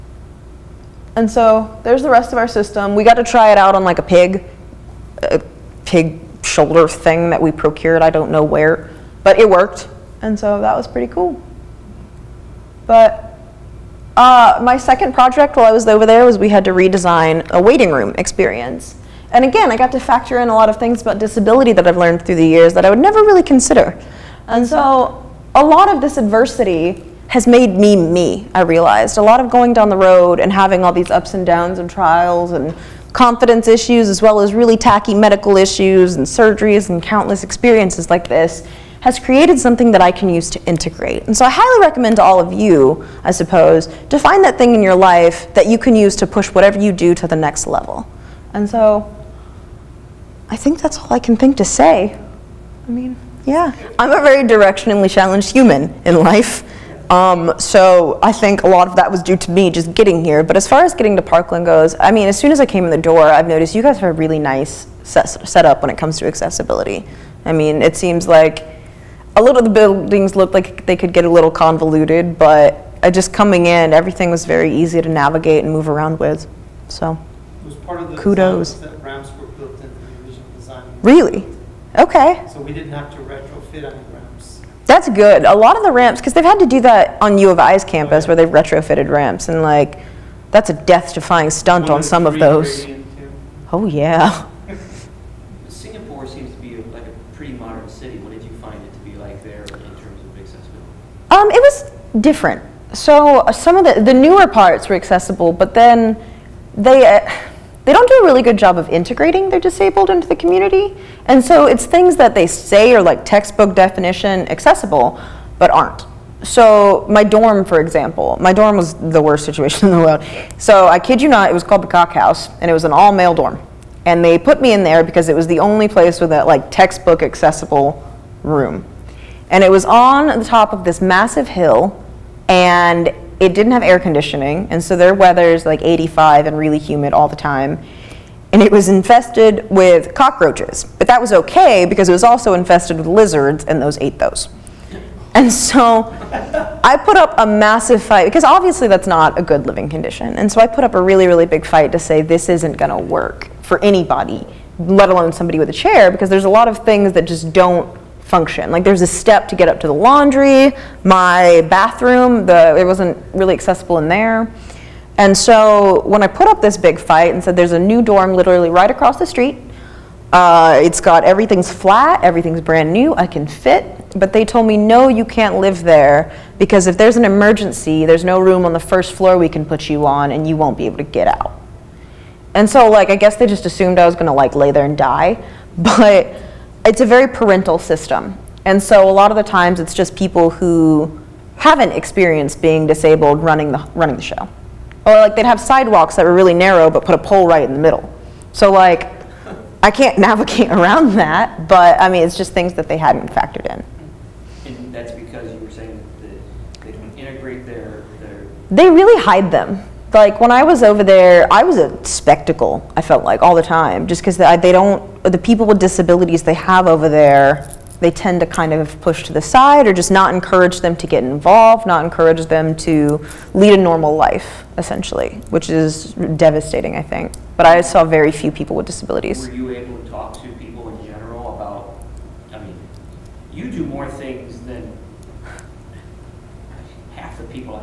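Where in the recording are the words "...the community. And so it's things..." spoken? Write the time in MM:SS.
01:50.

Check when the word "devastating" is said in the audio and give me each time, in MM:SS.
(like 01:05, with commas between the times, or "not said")
03:46.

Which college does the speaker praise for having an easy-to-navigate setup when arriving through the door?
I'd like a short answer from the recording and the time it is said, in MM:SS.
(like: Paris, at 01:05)
Parkland, at 01:01.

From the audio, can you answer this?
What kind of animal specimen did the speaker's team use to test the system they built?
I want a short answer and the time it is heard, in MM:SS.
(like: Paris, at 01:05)
Pig shoulder, at 00:05.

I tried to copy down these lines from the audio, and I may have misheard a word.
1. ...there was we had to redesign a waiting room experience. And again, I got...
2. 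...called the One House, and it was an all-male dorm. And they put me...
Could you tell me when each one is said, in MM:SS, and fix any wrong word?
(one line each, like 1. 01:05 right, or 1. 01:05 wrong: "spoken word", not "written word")
1. 00:16 right
2. 02:01 wrong: "Cock", not "One".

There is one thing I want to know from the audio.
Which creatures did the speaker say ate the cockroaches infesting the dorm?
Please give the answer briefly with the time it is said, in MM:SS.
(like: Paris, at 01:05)
Lizards, at 02:23.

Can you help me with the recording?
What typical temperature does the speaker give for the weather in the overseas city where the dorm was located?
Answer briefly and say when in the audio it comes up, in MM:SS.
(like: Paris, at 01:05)
85, at 02:15.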